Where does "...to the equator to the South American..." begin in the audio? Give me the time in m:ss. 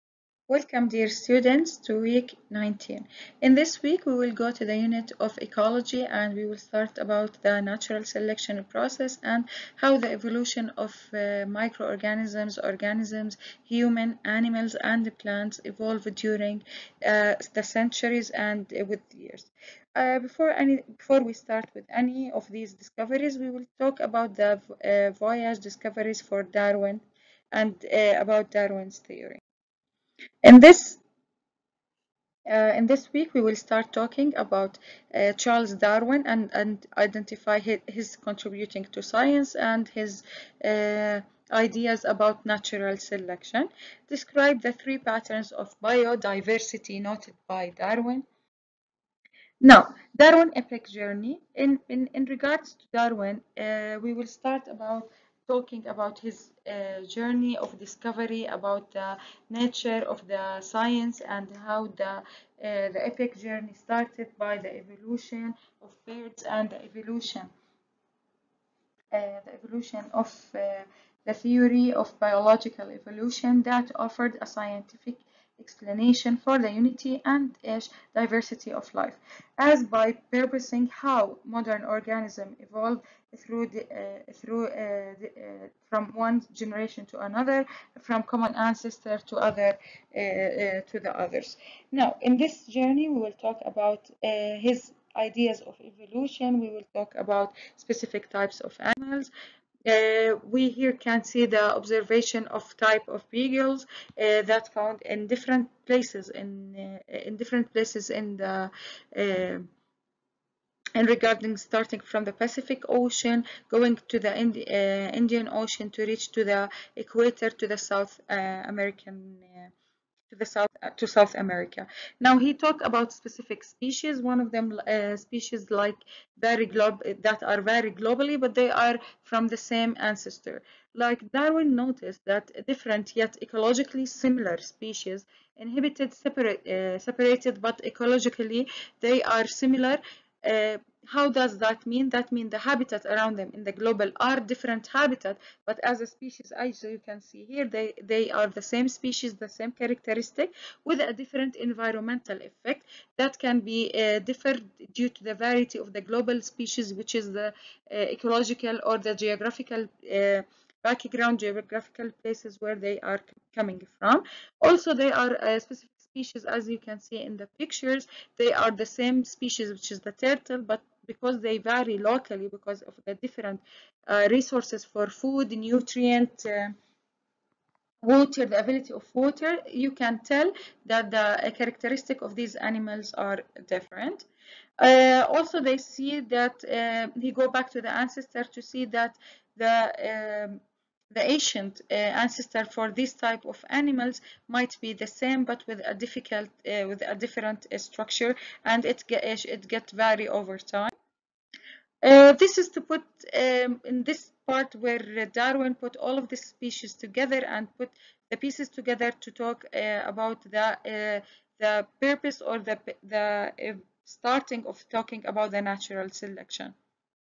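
1:56.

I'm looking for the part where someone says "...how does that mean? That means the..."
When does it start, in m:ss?
2:21.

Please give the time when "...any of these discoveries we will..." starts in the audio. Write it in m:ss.
0:21.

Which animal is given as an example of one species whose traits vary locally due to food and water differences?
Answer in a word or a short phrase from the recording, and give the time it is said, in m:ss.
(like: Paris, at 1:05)
turtle, at 2:50.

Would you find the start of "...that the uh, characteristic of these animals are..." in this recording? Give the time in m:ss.
3:00.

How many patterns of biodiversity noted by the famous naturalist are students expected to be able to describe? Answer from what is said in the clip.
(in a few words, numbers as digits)
3.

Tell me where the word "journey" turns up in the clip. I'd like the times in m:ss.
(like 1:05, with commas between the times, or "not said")
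0:50, 0:57, 1:03, 1:32.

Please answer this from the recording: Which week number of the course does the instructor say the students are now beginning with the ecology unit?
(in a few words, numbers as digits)
19.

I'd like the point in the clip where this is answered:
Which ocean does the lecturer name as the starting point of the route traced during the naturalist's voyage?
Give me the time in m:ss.
1:52.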